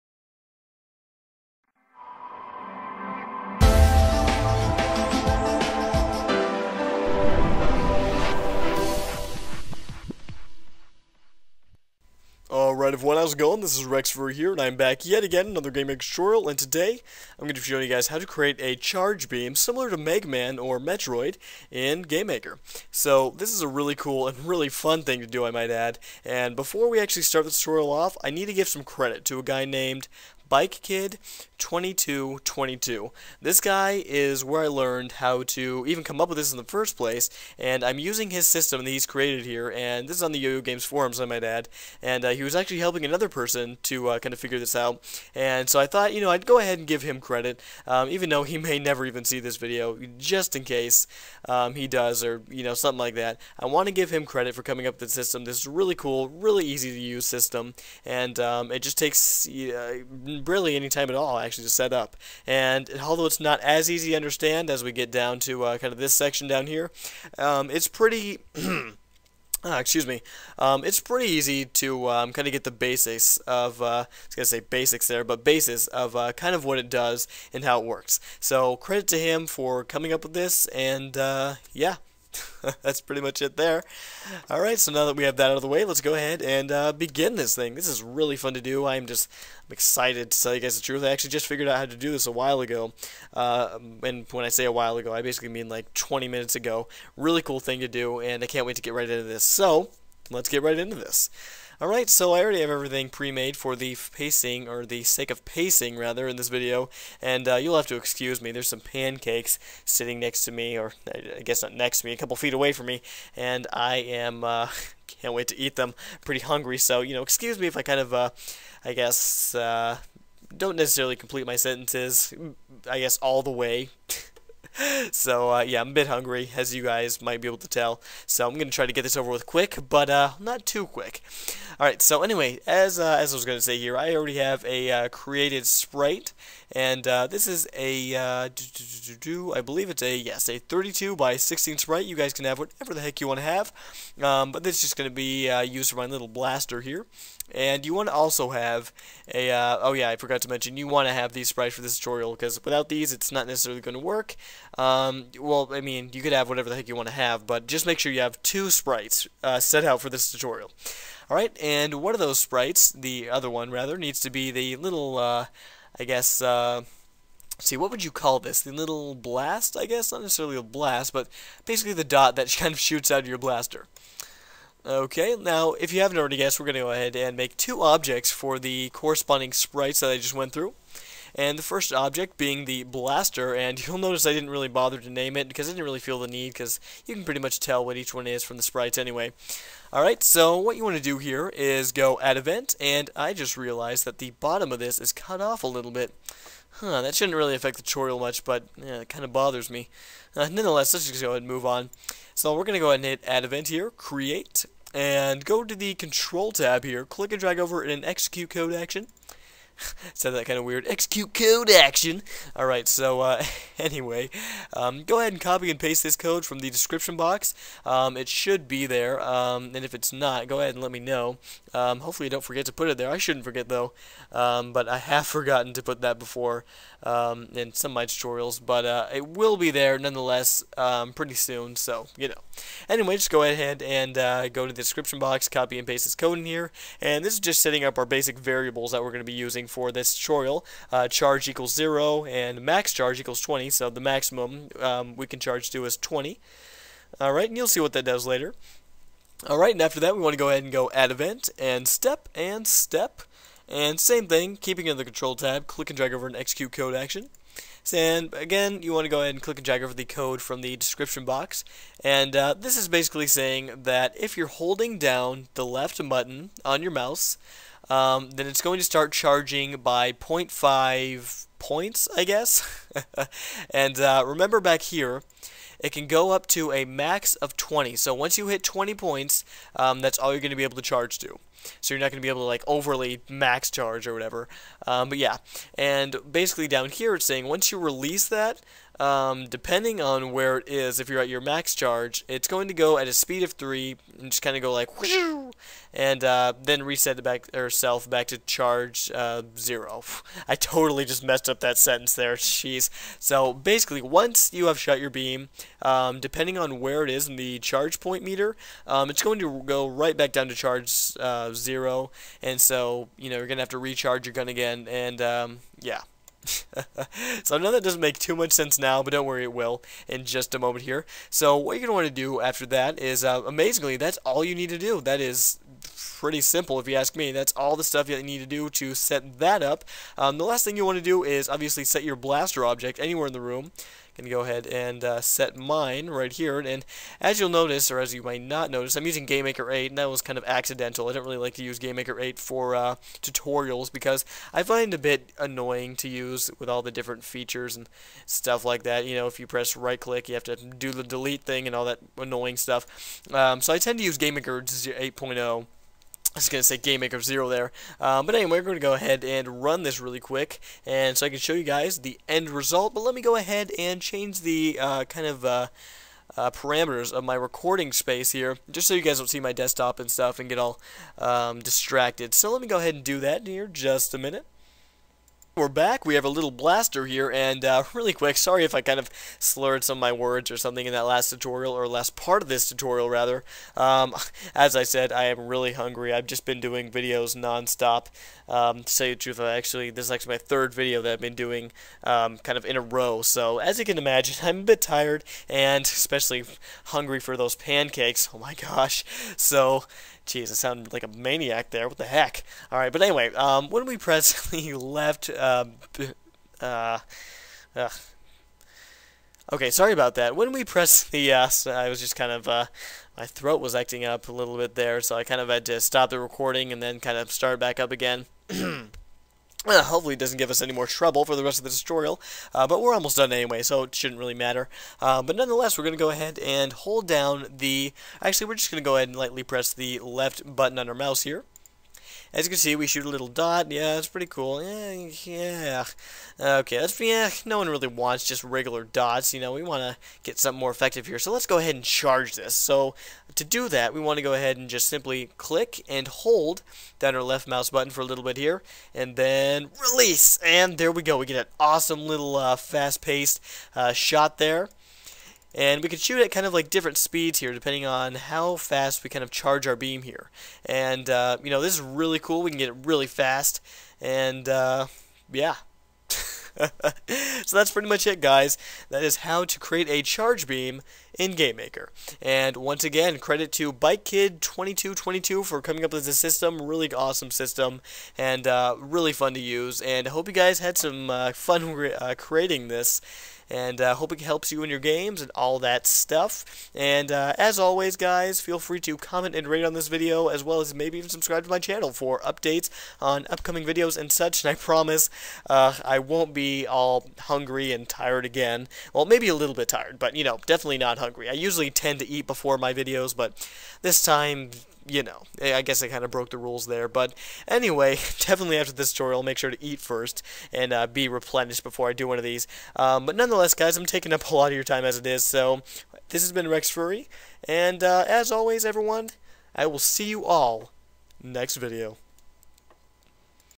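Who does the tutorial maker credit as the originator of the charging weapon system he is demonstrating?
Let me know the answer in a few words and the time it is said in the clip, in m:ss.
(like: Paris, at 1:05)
Bike Kid 2222, at 0:30.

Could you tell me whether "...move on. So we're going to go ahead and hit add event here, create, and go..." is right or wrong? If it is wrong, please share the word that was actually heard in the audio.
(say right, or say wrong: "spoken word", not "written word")
right.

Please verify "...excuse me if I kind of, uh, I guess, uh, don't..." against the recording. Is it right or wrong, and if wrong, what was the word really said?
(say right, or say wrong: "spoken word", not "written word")
right.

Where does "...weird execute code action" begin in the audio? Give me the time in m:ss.
3:30.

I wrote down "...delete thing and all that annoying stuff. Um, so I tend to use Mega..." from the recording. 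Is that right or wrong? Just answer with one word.
wrong.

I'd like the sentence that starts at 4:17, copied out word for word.
And again, you want to go ahead and click and drag over the code from the description box.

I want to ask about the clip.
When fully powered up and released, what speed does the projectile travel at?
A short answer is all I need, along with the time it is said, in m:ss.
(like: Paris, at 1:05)
3, at 4:53.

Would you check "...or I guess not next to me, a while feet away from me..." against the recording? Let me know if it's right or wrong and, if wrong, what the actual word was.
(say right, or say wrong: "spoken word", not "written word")
wrong: "couple", not "while".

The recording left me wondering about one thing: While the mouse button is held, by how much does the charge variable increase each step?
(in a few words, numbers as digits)
0.5.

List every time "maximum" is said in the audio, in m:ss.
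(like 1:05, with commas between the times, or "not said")
4:04.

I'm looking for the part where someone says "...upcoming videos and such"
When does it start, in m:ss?
8:13.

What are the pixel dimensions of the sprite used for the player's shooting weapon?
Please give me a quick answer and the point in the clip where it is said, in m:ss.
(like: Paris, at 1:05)
32 by 16, at 2:20.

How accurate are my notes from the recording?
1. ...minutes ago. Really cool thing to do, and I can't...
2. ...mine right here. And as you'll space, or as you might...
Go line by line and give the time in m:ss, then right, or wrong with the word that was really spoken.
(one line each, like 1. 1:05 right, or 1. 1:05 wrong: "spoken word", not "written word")
1. 1:36 right
2. 5:35 wrong: "notice", not "space".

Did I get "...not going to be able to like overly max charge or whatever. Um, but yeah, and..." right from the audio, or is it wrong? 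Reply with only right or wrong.
right.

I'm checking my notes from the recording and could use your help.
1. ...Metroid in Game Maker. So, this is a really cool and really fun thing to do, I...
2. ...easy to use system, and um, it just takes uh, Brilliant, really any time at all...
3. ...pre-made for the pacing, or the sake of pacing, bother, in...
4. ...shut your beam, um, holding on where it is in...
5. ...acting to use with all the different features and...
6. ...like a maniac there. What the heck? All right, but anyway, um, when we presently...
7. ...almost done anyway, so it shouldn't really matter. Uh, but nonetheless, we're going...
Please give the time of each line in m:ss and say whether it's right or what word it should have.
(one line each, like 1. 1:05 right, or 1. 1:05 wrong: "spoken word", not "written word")
1. 0:20 right
2. 0:56 right
3. 1:43 wrong: "rather", not "bother"
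4. 5:04 wrong: "depending", not "holding"
5. 5:45 wrong: "annoying", not "acting"
6. 6:40 right
7. 7:02 right.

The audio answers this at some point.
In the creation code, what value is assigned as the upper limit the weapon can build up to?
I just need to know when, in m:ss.
4:02.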